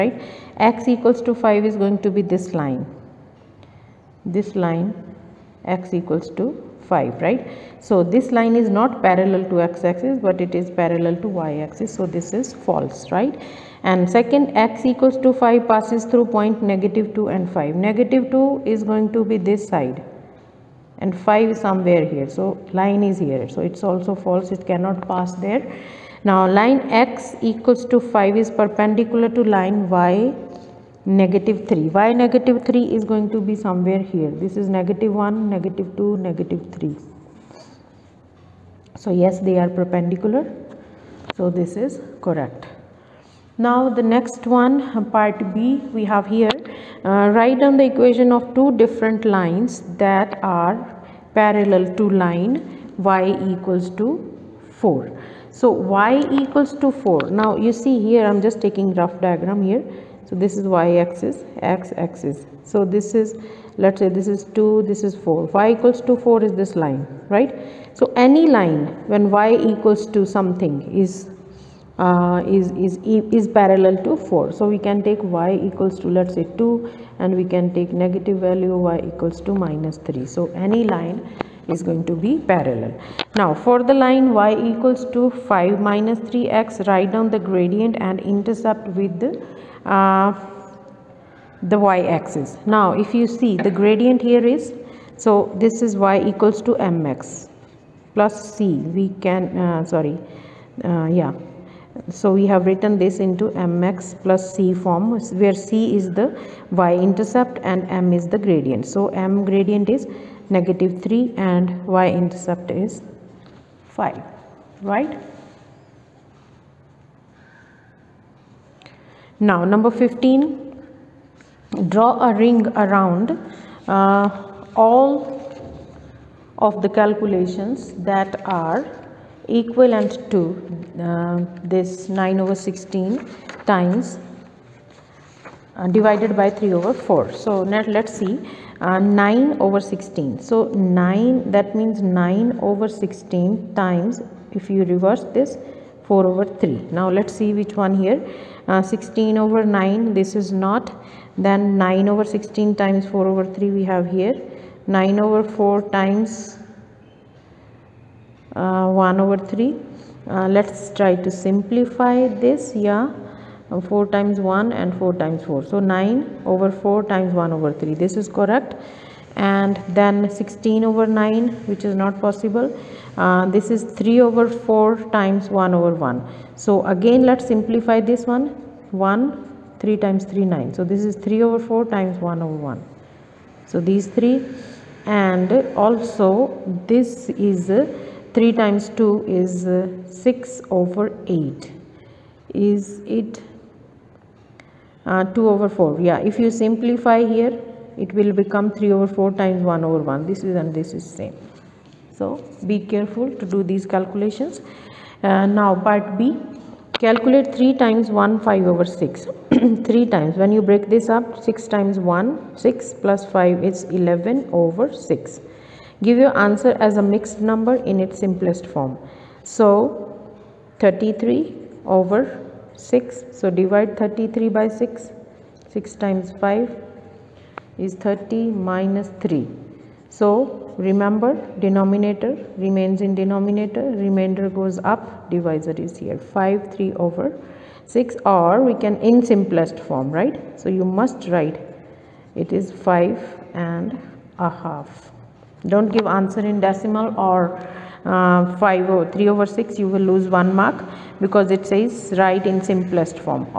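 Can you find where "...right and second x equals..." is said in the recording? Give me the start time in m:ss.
0:13.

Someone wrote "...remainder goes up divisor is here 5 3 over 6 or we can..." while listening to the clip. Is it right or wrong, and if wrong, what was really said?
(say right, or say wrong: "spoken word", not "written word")
right.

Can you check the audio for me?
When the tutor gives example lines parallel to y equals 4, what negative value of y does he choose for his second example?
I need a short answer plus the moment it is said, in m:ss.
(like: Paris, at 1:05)
-3, at 1:18.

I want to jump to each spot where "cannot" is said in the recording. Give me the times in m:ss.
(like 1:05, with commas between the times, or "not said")
0:24.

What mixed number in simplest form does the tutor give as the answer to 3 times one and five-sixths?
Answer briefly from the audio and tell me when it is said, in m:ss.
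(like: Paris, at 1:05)
5 and a half, at 4:02.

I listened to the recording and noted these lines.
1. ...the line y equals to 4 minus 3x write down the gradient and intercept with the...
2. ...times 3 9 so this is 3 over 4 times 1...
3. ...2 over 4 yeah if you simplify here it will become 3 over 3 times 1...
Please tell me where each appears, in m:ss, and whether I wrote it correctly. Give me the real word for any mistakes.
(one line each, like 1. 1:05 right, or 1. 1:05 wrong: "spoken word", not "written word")
1. 1:23 wrong: "5", not "4"
2. 3:00 right
3. 3:15 wrong: "4", not "3".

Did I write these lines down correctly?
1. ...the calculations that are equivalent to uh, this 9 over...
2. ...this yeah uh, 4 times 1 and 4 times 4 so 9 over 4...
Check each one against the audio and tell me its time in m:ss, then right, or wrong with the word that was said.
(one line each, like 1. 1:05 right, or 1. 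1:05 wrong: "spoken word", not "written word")
1. 2:06 right
2. 2:42 right.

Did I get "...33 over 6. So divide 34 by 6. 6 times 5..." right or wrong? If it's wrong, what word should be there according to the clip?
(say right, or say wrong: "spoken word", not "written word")
wrong: "33", not "34".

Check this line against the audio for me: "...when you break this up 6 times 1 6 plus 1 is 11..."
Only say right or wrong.
wrong.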